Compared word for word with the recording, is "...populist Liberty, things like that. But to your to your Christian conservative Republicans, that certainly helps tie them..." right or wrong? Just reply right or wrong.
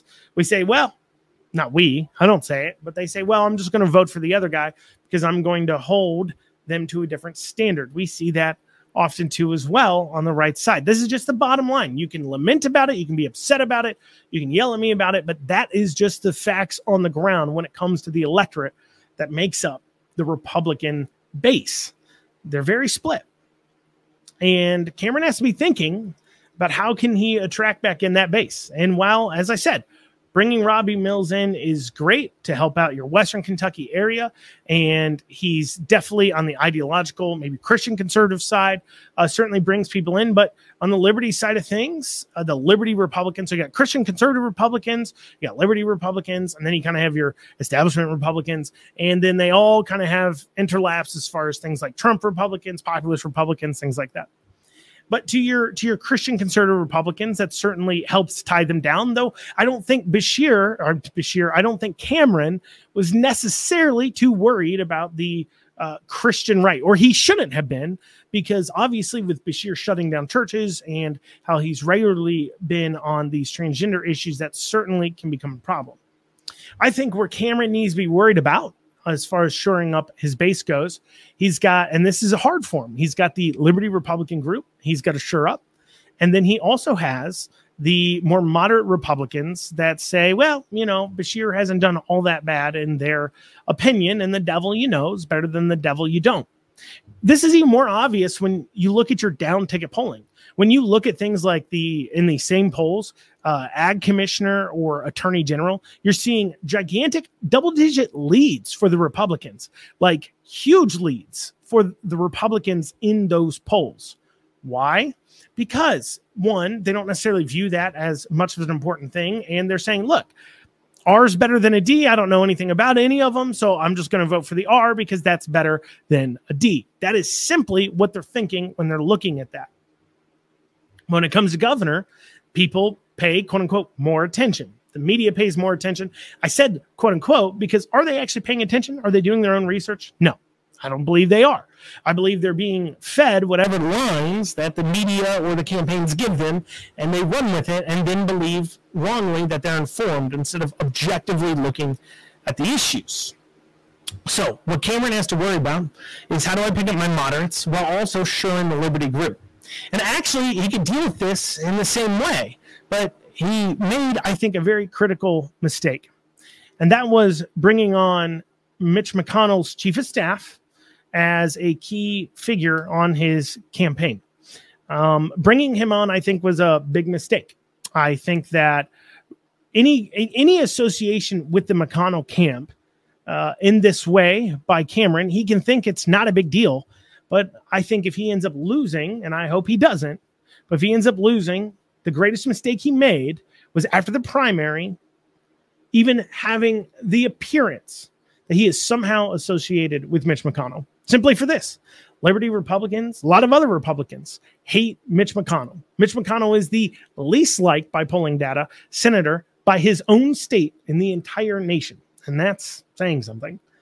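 wrong.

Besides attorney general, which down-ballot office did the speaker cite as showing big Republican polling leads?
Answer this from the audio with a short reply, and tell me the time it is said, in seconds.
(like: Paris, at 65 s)
Ag commissioner, at 103 s.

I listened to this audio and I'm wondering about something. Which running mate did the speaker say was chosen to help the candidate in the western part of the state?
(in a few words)
Robby Mills.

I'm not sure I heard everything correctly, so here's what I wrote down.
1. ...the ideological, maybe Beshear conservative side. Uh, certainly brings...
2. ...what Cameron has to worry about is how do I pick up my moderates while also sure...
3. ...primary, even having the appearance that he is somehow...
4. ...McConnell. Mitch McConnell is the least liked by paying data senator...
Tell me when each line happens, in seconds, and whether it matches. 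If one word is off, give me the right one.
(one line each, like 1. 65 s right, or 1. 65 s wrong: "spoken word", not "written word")
1. 36 s wrong: "Christian", not "Beshear"
2. 154 s right
3. 194 s right
4. 205 s wrong: "polling", not "paying".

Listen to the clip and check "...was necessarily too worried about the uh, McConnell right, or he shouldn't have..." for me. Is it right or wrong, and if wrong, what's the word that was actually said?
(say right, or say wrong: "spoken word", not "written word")
wrong: "Christian", not "McConnell".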